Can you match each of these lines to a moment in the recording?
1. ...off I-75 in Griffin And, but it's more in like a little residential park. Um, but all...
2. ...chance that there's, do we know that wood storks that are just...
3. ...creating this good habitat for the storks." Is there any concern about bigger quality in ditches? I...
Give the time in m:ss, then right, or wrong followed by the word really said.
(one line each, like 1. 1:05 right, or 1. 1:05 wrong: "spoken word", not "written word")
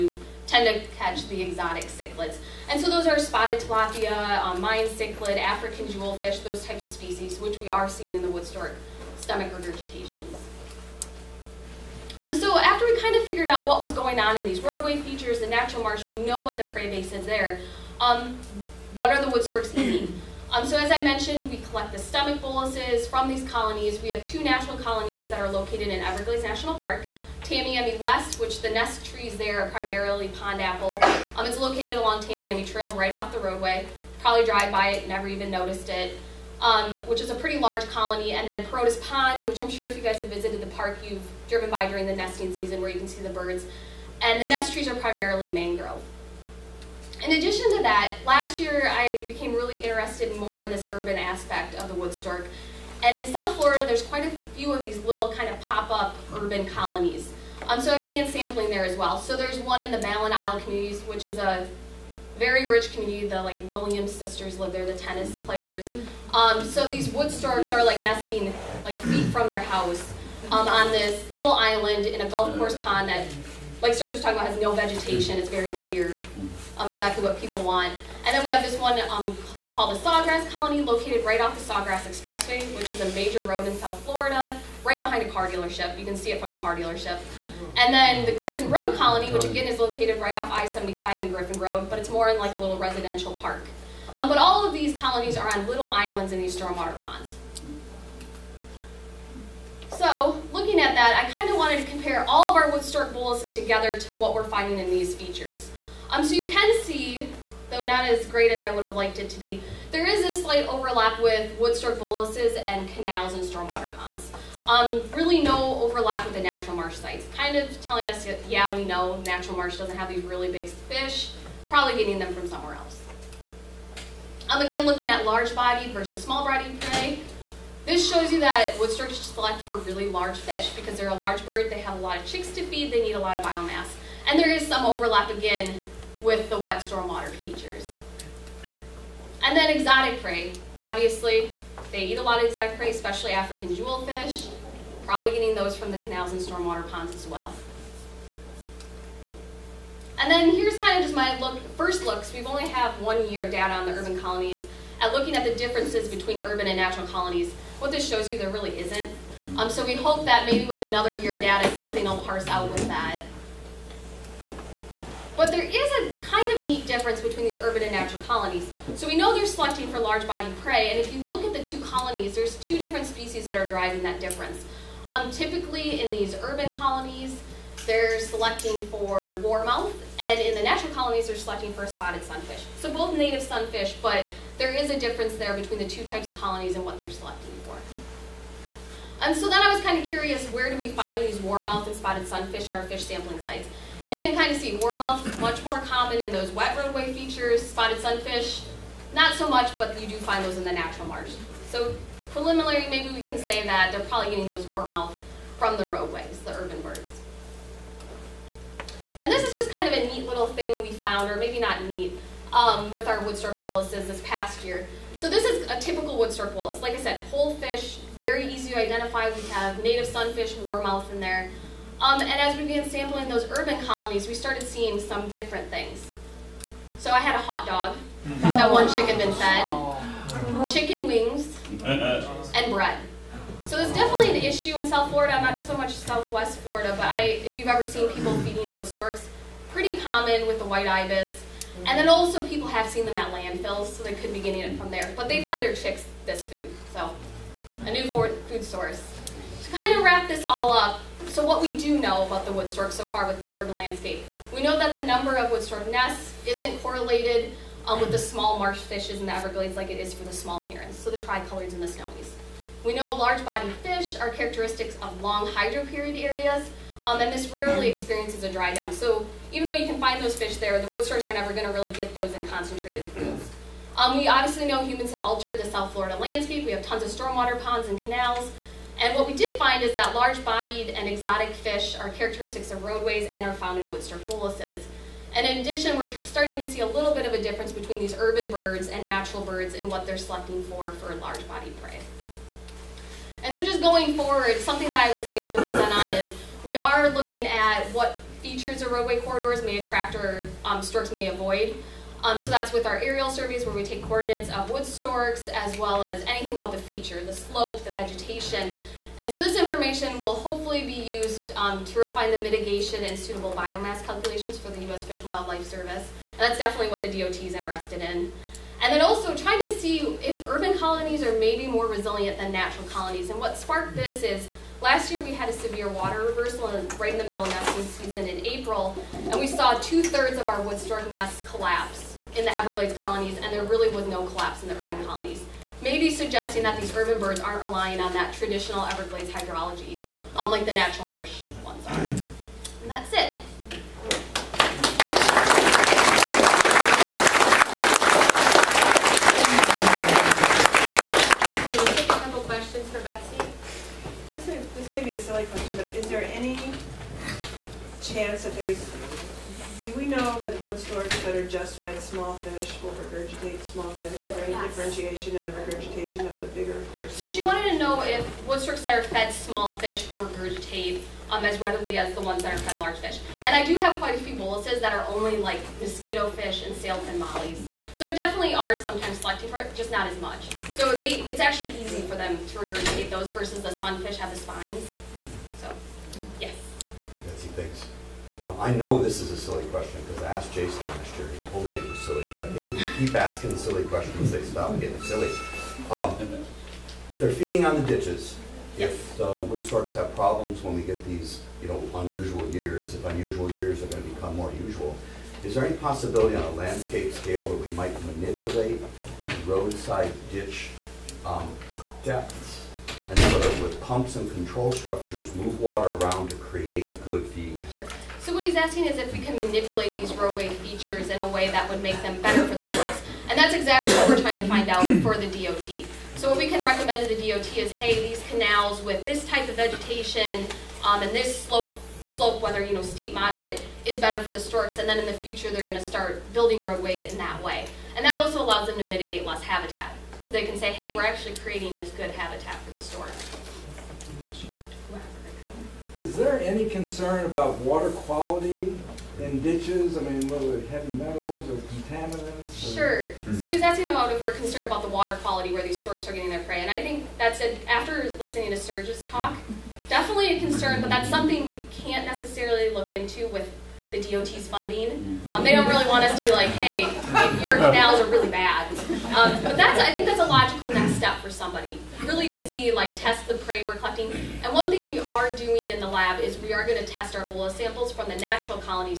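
1. 1:30 wrong: "Road", not "And"
2. 5:58 right
3. 7:21 wrong: "water", not "bigger".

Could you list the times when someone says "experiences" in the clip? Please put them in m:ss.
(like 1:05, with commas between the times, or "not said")
4:27.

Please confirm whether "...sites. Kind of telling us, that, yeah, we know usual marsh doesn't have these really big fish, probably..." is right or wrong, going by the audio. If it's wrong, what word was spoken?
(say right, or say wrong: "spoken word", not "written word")
wrong: "natural", not "usual".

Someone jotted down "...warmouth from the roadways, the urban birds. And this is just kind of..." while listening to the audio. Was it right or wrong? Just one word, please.
right.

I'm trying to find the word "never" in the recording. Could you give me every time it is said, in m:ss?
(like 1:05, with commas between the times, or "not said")
0:35, 4:31.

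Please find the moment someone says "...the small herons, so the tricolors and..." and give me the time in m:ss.
4:20.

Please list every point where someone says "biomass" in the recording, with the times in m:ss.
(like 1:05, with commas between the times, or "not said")
2:13, 5:13.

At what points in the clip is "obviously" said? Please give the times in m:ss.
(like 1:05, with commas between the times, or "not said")
2:20, 4:34.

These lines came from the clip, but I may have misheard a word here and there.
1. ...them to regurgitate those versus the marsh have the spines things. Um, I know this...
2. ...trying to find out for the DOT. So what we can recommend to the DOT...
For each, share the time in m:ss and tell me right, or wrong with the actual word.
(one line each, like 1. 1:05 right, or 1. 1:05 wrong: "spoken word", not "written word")
1. 6:22 wrong: "sunfish", not "marsh"
2. 7:04 right.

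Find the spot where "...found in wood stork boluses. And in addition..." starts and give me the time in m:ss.
4:43.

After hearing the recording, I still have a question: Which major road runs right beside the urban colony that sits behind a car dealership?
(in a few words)
Sawgrass Expressway.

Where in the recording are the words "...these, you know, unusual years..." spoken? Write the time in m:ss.
6:41.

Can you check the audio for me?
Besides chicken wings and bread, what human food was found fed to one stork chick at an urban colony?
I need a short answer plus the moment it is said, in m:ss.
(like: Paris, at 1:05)
A hot dog, at 3:47.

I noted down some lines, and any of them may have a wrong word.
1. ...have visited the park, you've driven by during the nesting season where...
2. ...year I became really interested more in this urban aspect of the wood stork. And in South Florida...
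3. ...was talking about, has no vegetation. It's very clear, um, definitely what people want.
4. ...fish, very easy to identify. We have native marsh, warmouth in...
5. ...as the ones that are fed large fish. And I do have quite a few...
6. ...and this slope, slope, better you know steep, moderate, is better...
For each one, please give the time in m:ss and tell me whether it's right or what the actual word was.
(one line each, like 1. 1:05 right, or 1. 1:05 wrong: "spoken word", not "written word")
1. 0:40 right
2. 0:48 right
3. 1:14 wrong: "exactly", not "definitely"
4. 3:37 wrong: "sunfish", not "marsh"
5. 6:11 right
6. 7:11 wrong: "whether", not "better".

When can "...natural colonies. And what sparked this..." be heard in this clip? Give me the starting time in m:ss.
5:22.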